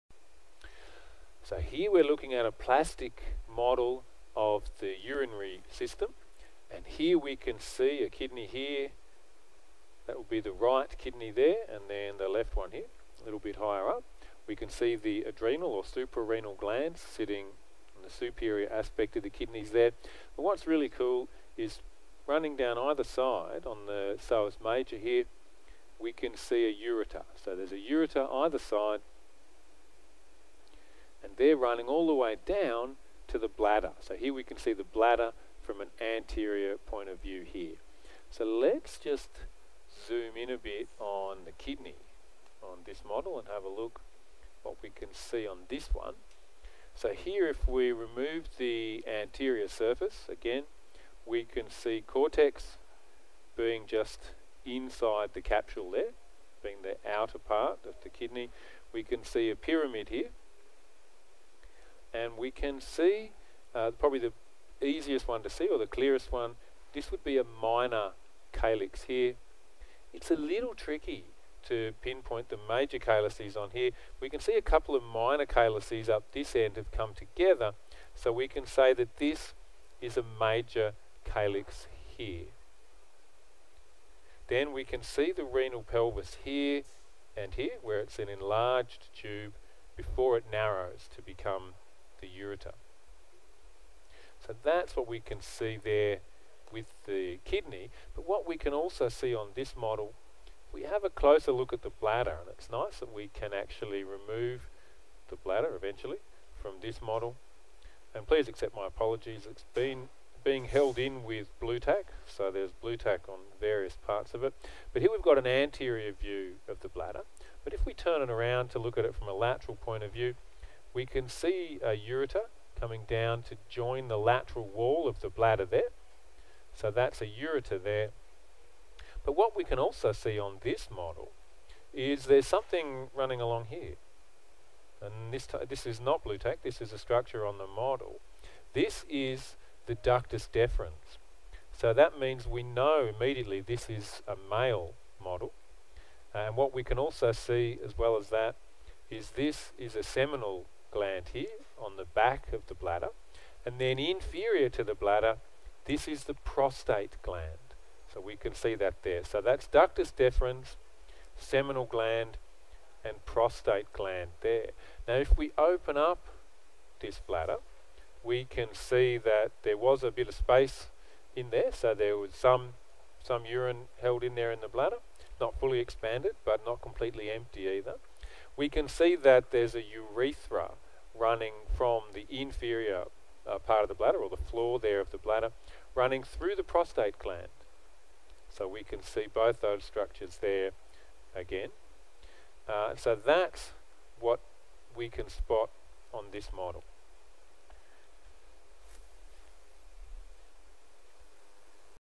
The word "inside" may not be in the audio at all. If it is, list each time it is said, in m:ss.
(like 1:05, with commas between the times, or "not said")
0:54.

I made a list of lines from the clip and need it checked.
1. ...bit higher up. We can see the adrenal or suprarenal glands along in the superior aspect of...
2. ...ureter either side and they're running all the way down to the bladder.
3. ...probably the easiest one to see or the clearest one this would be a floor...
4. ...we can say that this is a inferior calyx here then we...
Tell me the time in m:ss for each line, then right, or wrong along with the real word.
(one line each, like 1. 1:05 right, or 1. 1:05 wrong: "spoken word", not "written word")
1. 0:13 wrong: "sitting", not "along"
2. 0:27 right
3. 1:03 wrong: "minor", not "floor"
4. 1:18 wrong: "major", not "inferior".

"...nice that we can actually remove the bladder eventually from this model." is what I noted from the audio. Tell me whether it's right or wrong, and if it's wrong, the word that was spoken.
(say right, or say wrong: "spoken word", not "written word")
right.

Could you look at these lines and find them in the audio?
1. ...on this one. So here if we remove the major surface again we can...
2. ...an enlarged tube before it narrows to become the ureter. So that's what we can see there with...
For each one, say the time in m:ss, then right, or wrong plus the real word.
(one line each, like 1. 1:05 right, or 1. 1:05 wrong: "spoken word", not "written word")
1. 0:45 wrong: "anterior", not "major"
2. 1:28 right.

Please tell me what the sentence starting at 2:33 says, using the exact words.
And then inferior to the bladder, this is the prostate gland.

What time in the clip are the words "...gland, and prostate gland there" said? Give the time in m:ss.
2:41.